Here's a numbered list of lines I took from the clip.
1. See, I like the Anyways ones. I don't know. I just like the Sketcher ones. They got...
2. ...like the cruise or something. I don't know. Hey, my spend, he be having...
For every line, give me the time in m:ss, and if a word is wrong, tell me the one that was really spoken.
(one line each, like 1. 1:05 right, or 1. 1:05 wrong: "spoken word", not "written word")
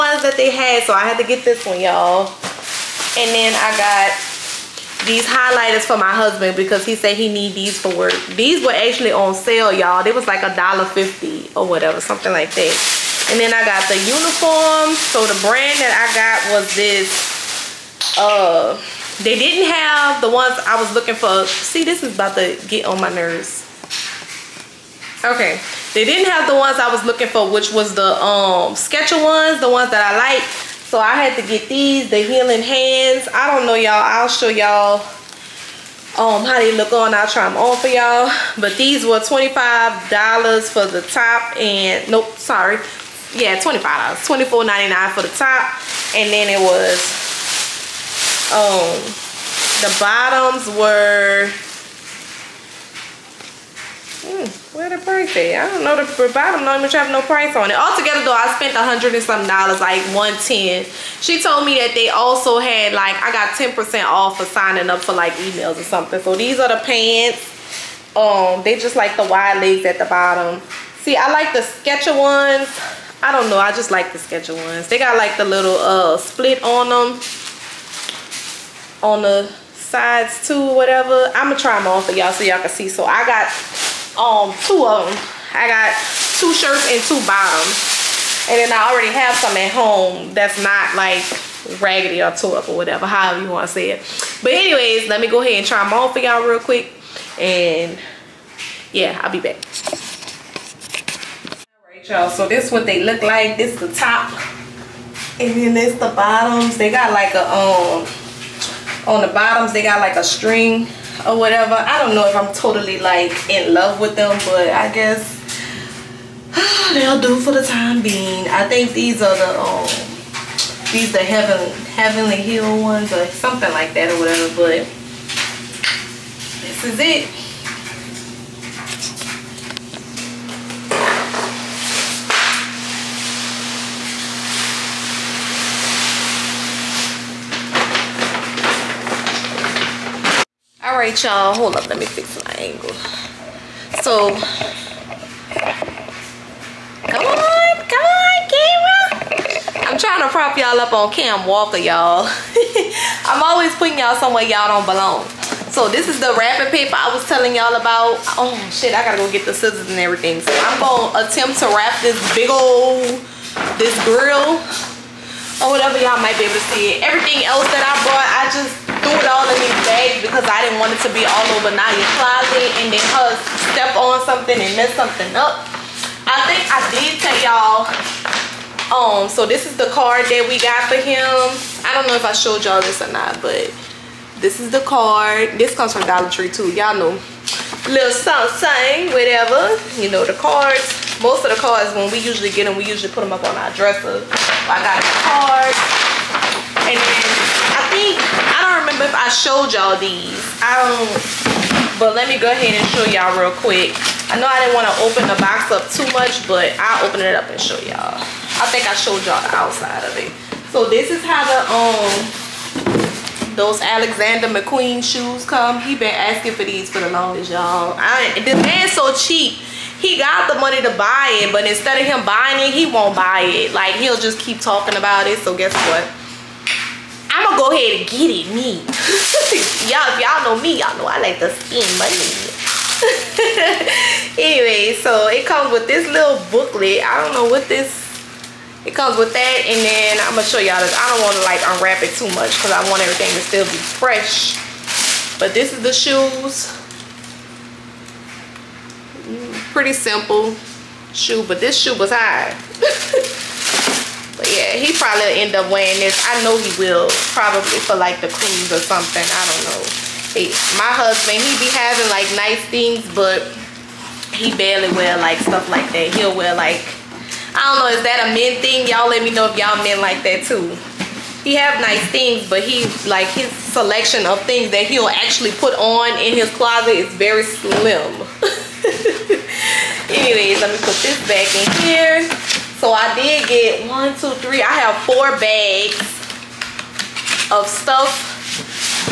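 1. 1:10 wrong: "Sketcher", not "Anyways"
2. 4:17 wrong: "husband", not "spend".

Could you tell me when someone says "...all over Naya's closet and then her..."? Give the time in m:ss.
2:51.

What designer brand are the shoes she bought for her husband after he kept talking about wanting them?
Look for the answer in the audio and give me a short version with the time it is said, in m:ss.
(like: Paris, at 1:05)
Alexander McQueen, at 3:33.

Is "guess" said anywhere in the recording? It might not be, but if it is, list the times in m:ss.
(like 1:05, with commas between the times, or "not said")
1:54, 3:45.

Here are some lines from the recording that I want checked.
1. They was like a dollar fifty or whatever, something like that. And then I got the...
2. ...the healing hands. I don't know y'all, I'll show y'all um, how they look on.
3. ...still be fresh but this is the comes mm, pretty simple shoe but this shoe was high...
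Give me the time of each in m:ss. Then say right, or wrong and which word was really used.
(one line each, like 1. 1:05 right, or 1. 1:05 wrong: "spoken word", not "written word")
1. 0:10 right
2. 0:32 right
3. 4:03 wrong: "shoes", not "comes".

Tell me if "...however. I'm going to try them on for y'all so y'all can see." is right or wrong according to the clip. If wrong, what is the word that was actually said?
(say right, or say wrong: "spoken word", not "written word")
wrong: "whatever", not "however".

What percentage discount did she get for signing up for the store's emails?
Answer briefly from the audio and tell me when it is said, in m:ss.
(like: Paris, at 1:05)
10%, at 1:03.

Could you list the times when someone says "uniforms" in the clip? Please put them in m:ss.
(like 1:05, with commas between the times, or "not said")
0:13.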